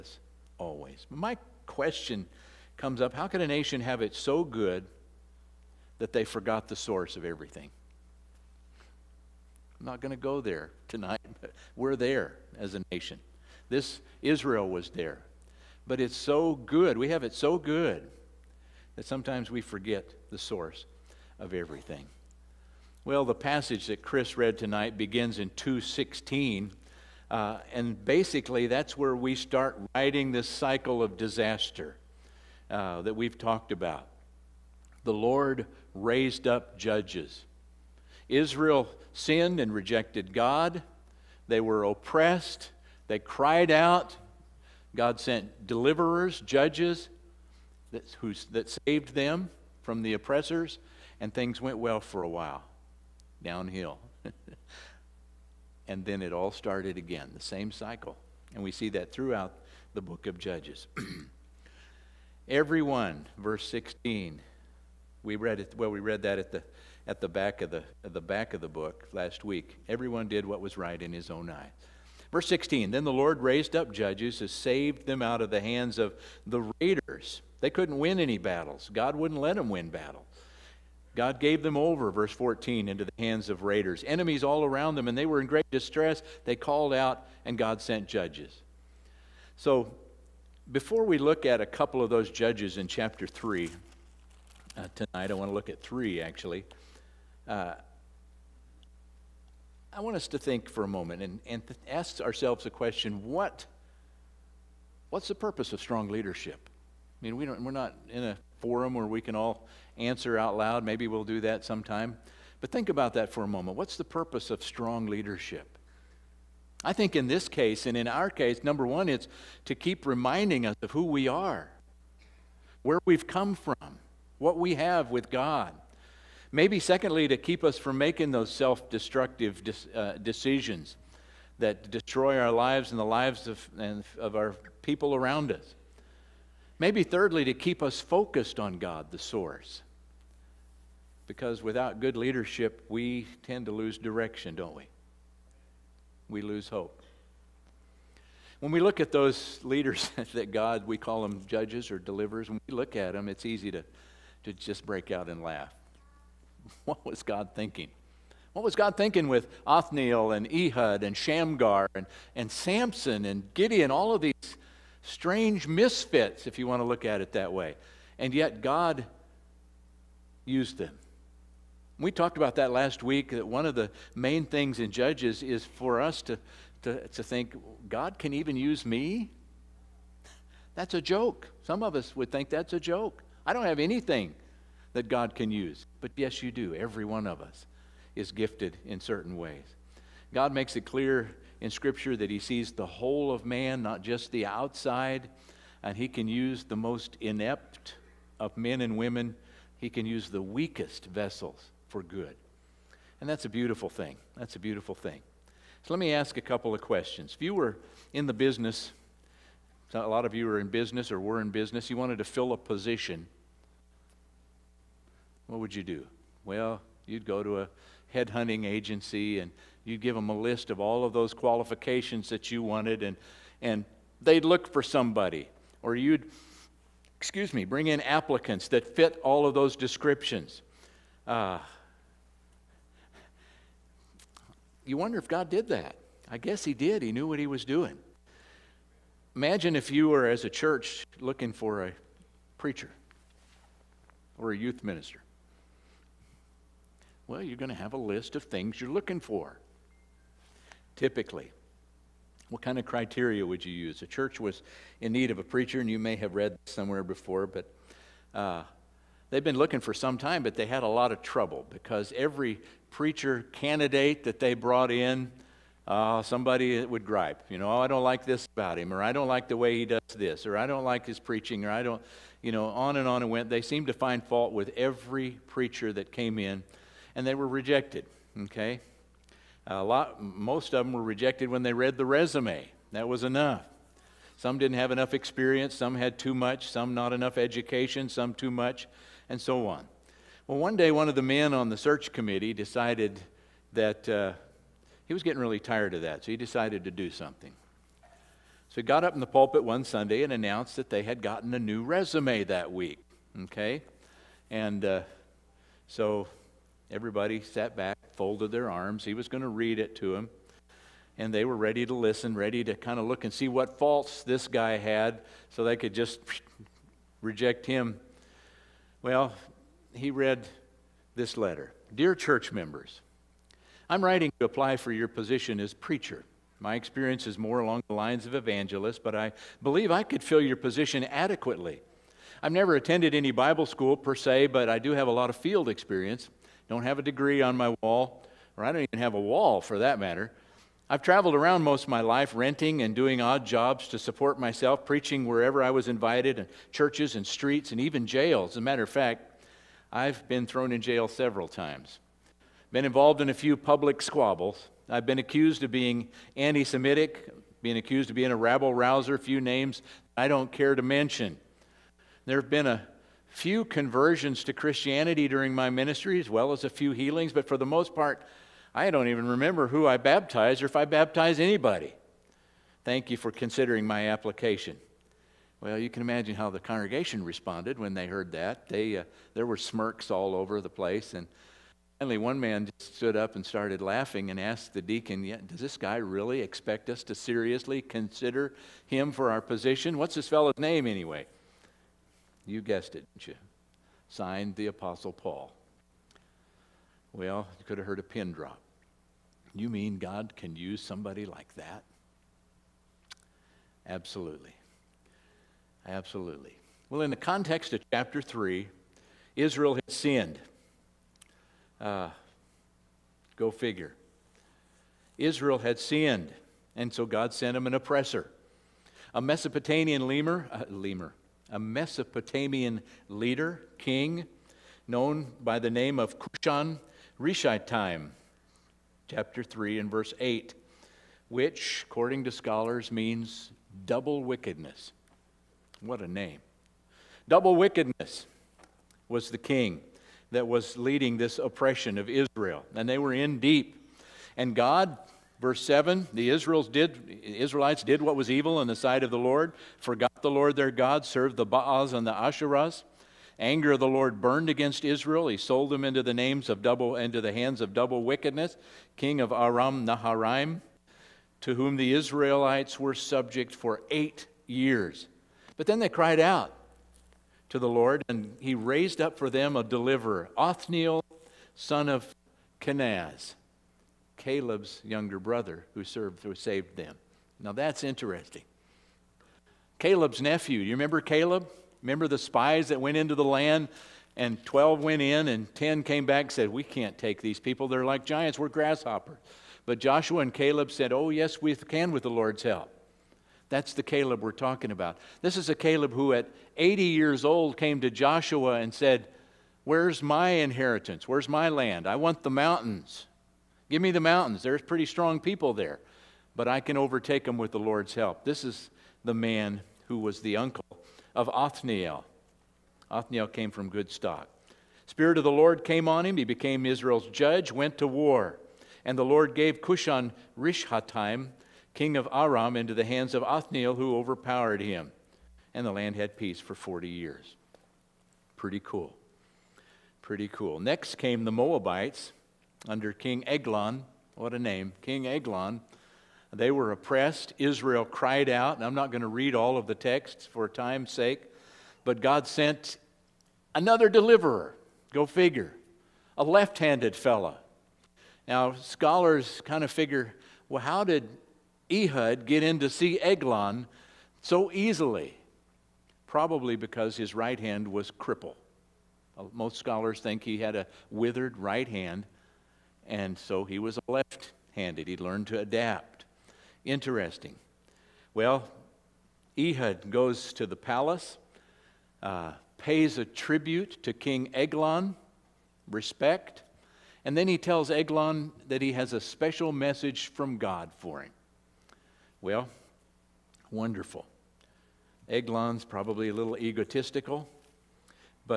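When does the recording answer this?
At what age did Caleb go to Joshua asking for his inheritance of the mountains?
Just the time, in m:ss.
8:16.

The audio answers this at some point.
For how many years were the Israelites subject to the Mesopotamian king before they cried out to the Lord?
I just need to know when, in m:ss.
7:43.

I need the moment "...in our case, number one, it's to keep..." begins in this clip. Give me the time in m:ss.
1:57.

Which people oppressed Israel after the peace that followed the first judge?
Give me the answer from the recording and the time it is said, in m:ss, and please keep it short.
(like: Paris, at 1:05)
The Moabites, at 8:51.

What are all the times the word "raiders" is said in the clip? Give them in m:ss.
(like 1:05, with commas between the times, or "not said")
1:16, 1:23.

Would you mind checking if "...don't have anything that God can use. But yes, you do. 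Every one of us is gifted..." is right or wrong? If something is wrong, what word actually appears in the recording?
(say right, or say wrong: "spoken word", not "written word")
right.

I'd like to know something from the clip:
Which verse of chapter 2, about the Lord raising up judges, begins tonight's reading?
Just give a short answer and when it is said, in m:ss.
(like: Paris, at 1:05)
2:16, at 0:25.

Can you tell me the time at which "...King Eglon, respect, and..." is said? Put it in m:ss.
9:33.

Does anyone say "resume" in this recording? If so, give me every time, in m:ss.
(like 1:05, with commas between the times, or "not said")
4:42, 5:01.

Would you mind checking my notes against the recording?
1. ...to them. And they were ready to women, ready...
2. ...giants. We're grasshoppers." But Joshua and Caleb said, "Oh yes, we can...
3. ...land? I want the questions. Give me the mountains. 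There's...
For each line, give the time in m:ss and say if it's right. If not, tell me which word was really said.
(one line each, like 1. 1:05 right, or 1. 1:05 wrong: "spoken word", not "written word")
1. 5:09 wrong: "listen", not "women"
2. 8:08 right
3. 8:21 wrong: "mountains", not "questions".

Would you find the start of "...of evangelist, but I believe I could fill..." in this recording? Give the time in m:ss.
5:28.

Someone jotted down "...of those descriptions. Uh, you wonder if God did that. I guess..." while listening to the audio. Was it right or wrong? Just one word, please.
right.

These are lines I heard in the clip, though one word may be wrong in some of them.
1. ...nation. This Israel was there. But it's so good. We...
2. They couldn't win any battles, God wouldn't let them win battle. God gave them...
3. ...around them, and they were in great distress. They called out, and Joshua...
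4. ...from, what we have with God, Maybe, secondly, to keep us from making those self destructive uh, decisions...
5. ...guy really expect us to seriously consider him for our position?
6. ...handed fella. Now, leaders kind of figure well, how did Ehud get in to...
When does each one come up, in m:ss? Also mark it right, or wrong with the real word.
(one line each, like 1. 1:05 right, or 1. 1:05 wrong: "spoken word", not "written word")
1. 0:12 right
2. 1:17 right
3. 1:24 wrong: "God", not "Joshua"
4. 2:03 right
5. 6:25 right
6. 9:06 wrong: "scholars", not "leaders".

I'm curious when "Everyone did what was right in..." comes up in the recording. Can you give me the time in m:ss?
1:09.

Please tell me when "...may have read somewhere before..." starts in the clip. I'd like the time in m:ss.
4:15.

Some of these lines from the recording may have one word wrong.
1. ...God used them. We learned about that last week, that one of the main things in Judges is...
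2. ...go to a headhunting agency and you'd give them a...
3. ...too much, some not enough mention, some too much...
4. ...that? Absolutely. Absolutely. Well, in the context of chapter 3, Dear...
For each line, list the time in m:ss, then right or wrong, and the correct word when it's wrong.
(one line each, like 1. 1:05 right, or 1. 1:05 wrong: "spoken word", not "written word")
1. 2:48 wrong: "talked", not "learned"
2. 3:37 right
3. 4:46 wrong: "education", not "mention"
4. 6:41 wrong: "Israel", not "Dear".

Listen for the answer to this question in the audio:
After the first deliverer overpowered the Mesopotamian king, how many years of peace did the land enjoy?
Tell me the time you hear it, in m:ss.
8:46.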